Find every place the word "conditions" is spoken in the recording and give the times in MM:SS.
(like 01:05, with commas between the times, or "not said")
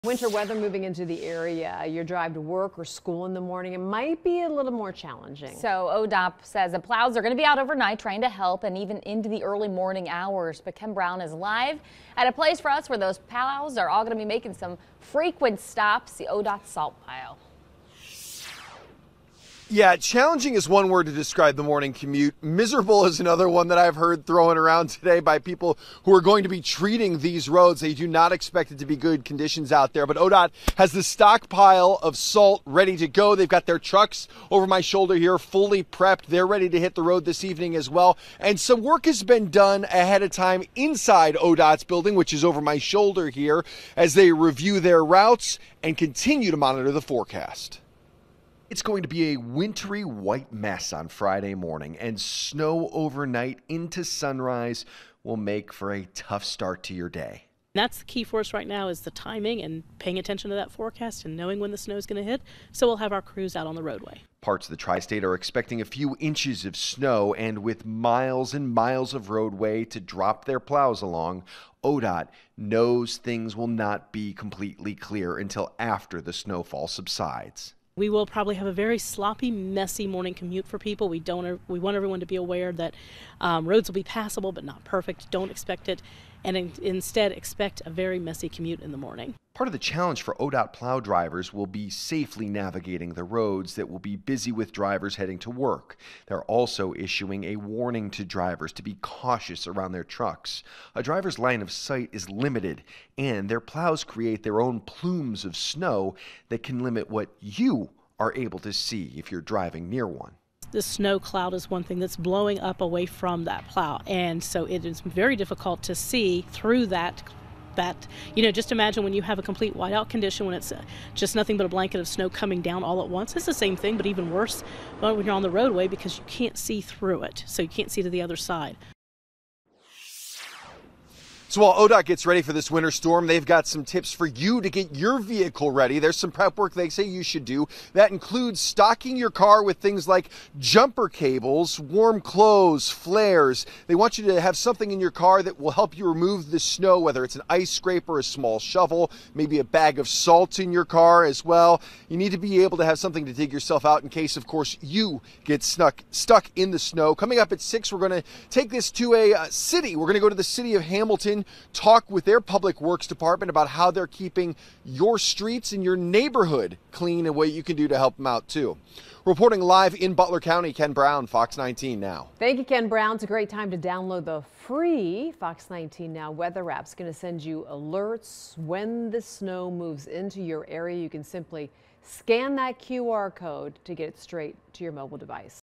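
00:29, 02:00.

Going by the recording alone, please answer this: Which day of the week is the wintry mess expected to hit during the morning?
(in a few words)
Friday.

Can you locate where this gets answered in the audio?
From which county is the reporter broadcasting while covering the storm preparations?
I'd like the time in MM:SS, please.
02:50.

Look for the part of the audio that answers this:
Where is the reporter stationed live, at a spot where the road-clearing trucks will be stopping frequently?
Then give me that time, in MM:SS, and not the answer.
00:16.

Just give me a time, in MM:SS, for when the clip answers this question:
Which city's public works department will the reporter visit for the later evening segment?
02:40.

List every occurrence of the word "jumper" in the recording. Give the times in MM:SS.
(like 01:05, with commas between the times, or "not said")
02:20.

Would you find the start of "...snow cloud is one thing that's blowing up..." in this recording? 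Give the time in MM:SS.
01:50.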